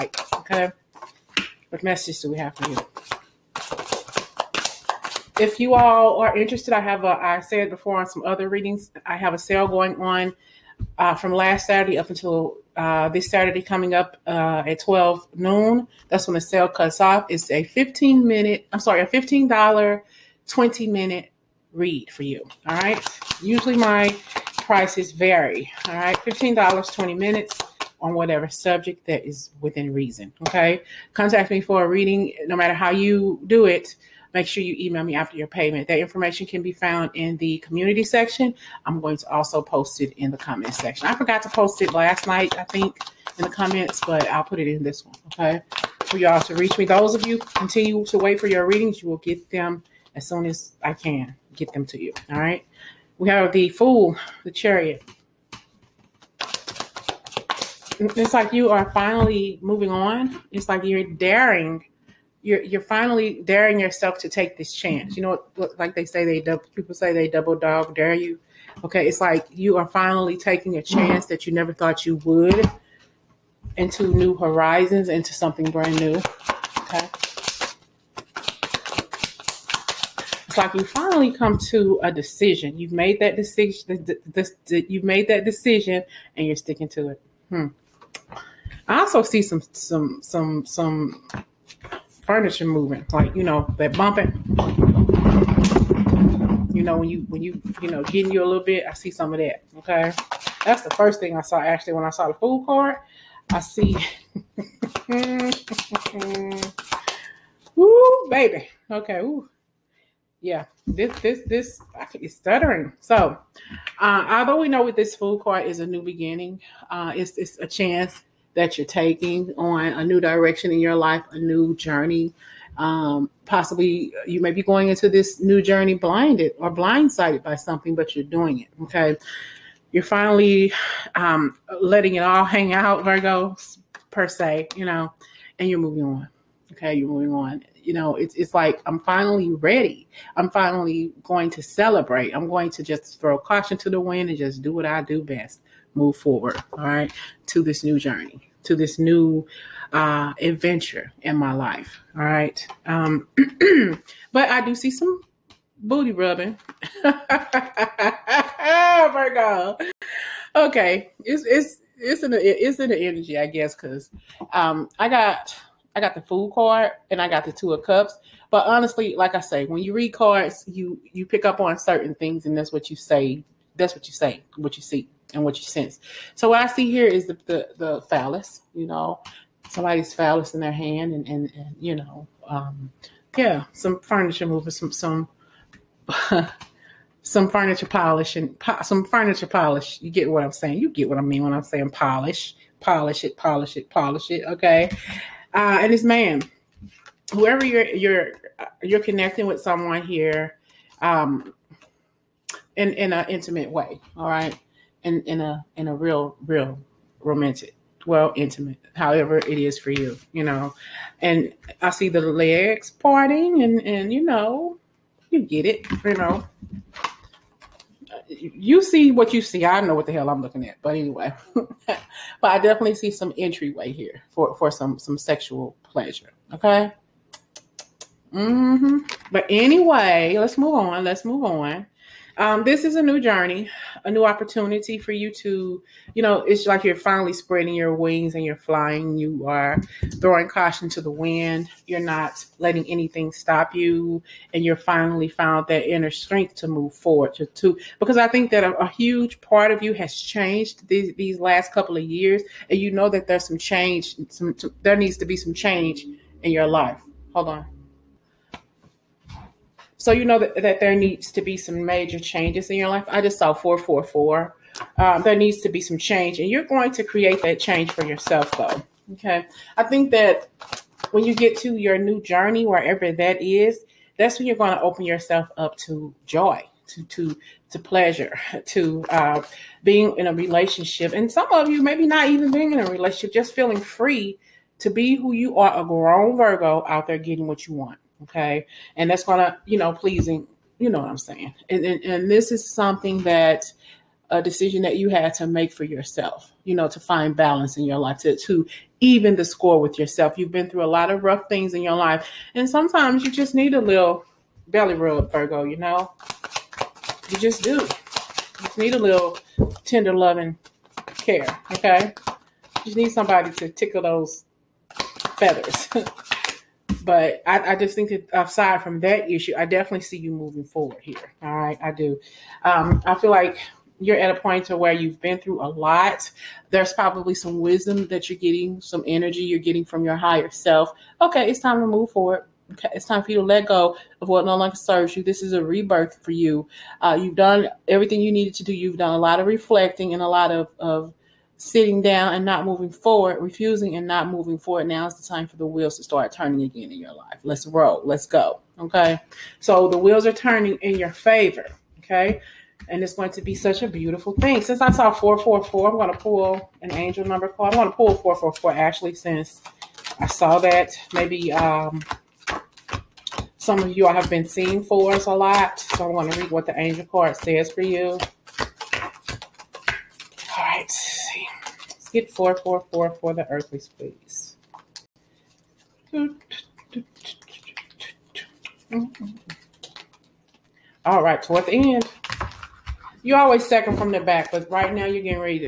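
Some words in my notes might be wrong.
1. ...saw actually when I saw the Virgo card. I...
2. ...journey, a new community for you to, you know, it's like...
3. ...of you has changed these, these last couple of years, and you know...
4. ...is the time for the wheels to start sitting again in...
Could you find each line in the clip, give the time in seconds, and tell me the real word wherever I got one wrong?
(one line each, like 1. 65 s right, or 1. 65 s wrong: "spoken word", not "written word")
1. 101 s wrong: "Fool", not "Virgo"
2. 233 s wrong: "opportunity", not "community"
3. 249 s right
4. 345 s wrong: "turning", not "sitting".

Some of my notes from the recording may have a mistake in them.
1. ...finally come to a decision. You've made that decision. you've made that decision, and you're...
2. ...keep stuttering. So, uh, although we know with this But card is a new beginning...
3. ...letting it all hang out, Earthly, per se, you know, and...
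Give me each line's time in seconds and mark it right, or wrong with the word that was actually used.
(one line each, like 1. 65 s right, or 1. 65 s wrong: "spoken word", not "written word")
1. 80 s right
2. 112 s wrong: "Fool", not "But"
3. 131 s wrong: "Virgo", not "Earthly".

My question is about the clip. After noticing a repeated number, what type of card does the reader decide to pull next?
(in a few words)
An angel number card.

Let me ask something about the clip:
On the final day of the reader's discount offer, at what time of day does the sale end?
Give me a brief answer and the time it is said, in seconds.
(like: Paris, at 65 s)
12 noon, at 14 s.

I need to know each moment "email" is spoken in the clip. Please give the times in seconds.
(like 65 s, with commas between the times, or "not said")
34 s.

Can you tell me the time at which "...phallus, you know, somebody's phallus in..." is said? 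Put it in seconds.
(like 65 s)
178 s.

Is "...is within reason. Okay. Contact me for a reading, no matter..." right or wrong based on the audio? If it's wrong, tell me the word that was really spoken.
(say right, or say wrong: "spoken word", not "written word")
right.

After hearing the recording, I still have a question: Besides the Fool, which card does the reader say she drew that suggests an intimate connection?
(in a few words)
Two of Cups.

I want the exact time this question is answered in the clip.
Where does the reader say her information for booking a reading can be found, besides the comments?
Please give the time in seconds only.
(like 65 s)
37 s.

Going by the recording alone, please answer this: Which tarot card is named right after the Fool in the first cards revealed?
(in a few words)
The Chariot.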